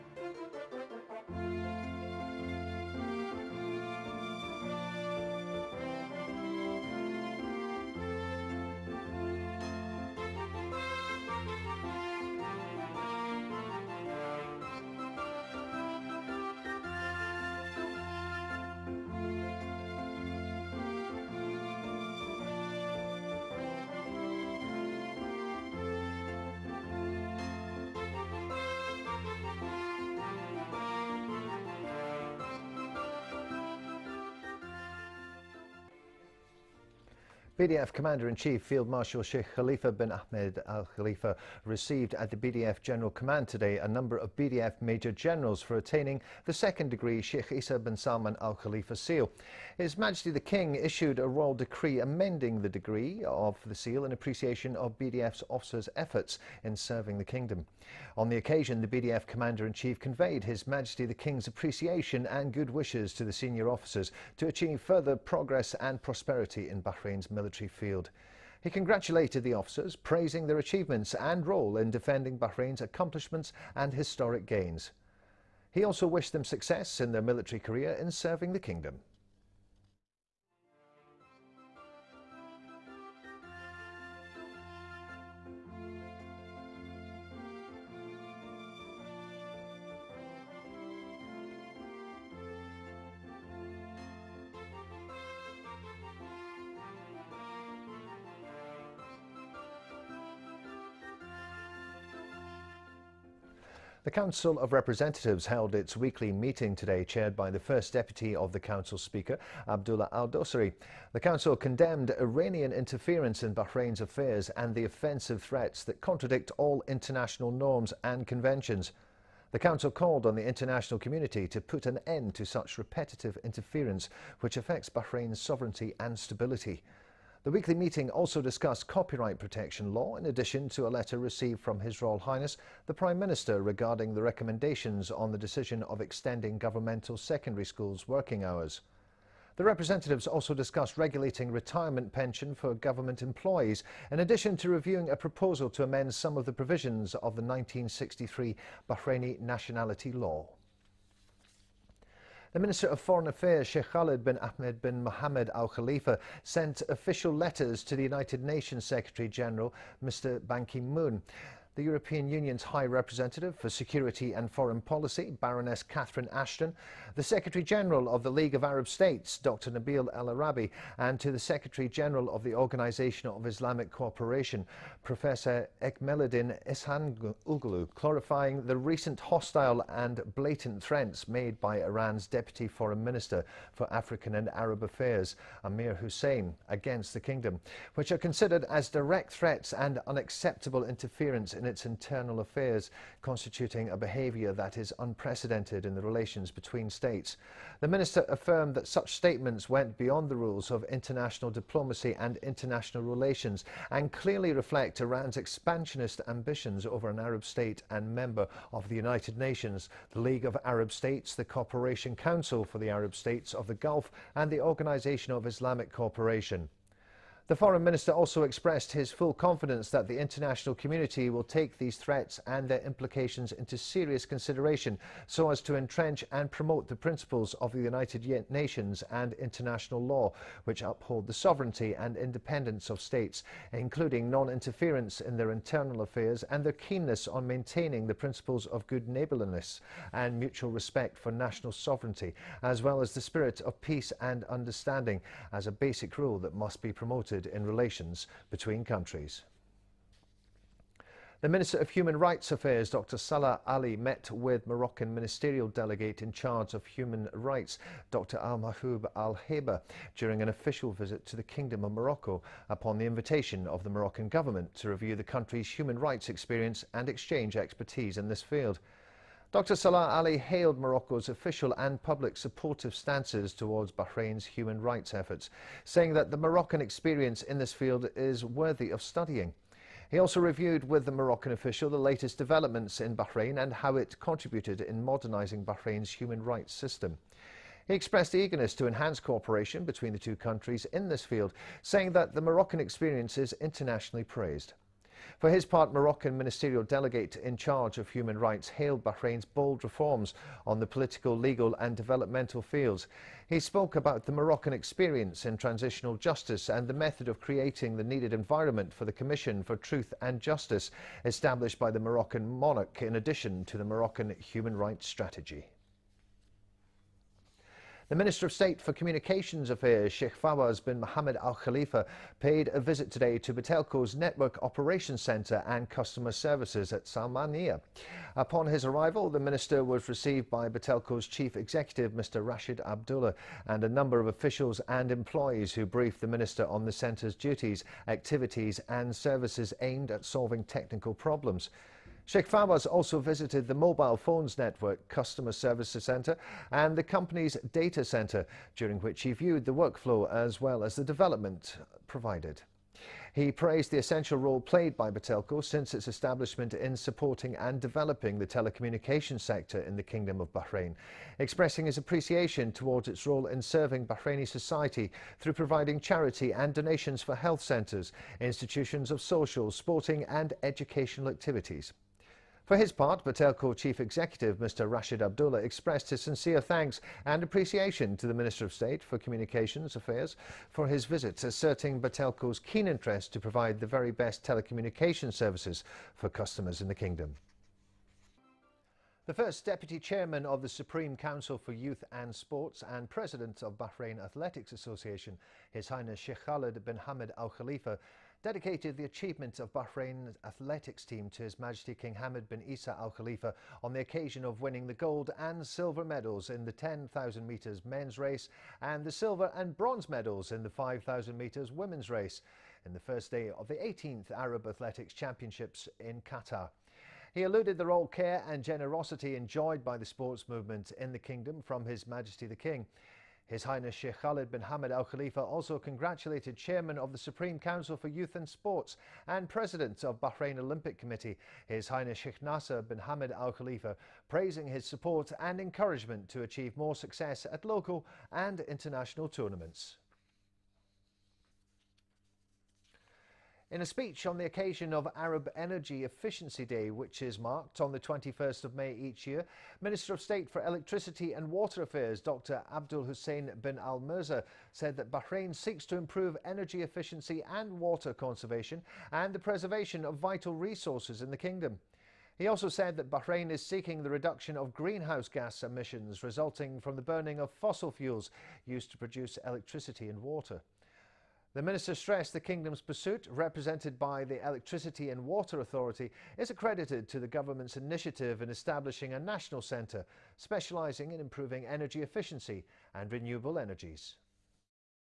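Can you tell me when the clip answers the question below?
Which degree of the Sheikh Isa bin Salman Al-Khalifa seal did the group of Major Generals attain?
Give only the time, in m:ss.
0:46.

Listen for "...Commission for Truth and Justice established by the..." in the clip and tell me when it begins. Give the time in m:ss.
5:09.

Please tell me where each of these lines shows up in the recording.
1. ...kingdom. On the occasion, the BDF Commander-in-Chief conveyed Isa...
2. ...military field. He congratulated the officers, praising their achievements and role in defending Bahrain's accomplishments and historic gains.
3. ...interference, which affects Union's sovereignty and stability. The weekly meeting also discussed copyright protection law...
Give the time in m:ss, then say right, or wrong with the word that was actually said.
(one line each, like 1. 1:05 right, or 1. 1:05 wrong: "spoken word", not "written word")
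1. 0:57 wrong: "His", not "Isa"
2. 1:07 right
3. 2:03 wrong: "Bahrain", not "Union".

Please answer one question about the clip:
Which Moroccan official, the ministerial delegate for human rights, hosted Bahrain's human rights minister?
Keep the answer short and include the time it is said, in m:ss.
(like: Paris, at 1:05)
Al Mahoub Al Heba, at 4:18.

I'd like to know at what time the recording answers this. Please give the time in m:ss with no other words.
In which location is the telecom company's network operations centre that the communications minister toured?
5:27.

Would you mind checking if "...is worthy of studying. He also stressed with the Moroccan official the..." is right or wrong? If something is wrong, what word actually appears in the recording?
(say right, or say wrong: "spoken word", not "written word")
wrong: "reviewed", not "stressed".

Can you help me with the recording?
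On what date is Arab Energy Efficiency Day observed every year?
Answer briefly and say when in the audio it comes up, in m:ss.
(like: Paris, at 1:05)
21 May, at 7:27.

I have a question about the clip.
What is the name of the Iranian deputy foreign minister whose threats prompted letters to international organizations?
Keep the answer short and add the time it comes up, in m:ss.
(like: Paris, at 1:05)
Amir Hussein, at 3:05.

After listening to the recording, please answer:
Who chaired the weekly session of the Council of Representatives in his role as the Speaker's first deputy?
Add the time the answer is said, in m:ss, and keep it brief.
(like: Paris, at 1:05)
Abdullah Al Dosari, at 1:49.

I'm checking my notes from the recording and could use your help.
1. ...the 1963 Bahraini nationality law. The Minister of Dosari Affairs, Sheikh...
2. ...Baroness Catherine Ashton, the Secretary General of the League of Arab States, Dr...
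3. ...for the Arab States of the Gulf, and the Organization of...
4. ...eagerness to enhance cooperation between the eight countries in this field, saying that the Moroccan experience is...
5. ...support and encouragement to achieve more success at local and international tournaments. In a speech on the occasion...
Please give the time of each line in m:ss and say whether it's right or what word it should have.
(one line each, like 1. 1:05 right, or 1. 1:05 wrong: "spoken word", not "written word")
1. 2:27 wrong: "Foreign", not "Dosari"
2. 2:45 right
3. 3:32 right
4. 4:48 wrong: "two", not "eight"
5. 7:14 right.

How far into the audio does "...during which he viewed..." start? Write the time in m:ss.
5:48.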